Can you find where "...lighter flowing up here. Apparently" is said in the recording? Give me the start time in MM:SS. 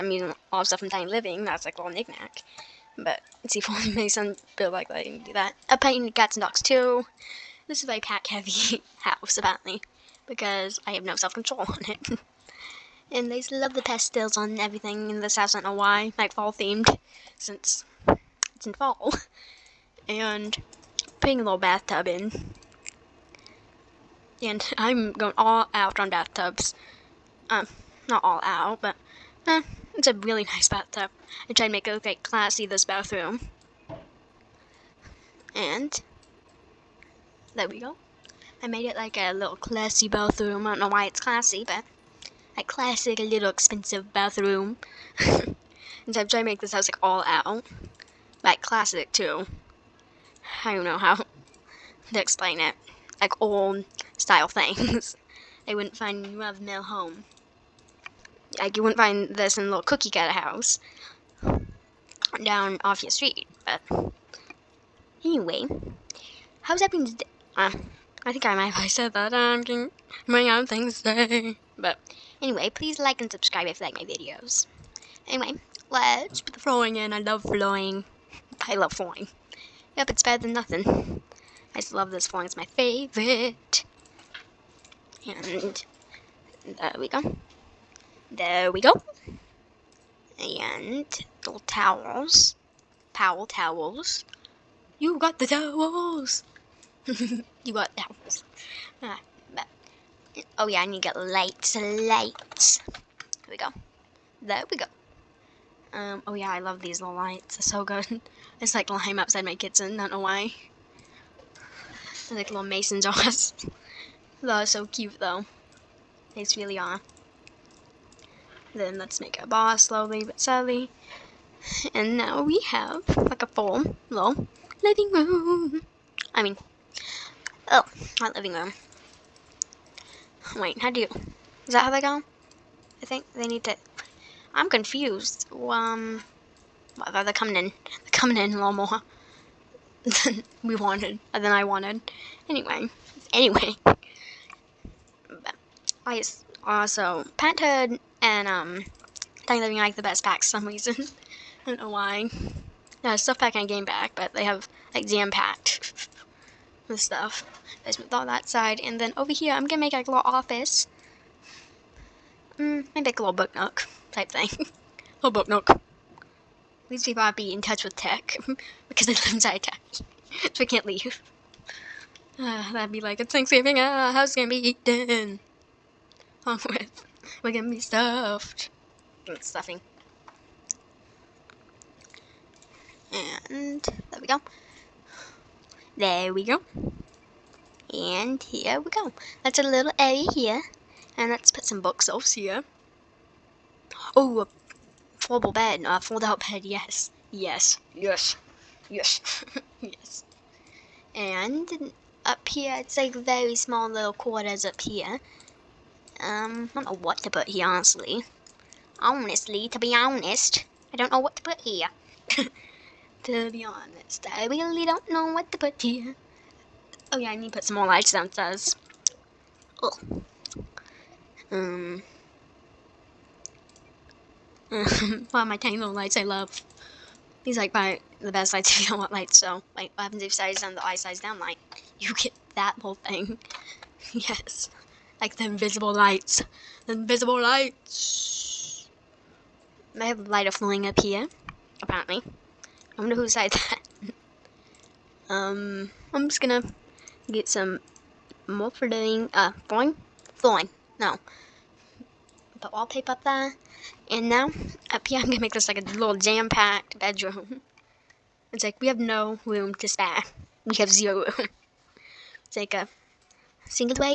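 04:00.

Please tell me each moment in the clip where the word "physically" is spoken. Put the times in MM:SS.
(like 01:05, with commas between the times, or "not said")
not said.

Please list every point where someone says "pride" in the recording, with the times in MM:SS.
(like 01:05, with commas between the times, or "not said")
not said.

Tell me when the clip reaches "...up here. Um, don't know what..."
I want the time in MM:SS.
03:24.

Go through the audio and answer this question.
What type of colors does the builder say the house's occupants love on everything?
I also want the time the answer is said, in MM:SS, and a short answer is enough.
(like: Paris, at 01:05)
pastels, at 00:13.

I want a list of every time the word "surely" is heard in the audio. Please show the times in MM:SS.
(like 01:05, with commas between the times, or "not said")
02:00.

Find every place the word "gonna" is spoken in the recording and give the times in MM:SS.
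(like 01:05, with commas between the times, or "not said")
02:39, 02:57, 04:06, 04:15.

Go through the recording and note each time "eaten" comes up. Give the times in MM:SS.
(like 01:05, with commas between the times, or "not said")
02:54.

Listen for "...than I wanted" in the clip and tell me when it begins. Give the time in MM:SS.
02:21.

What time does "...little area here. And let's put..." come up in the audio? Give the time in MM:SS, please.
03:09.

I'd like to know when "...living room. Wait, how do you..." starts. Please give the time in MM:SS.
02:08.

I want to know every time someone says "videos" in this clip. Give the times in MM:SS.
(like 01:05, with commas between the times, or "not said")
01:14.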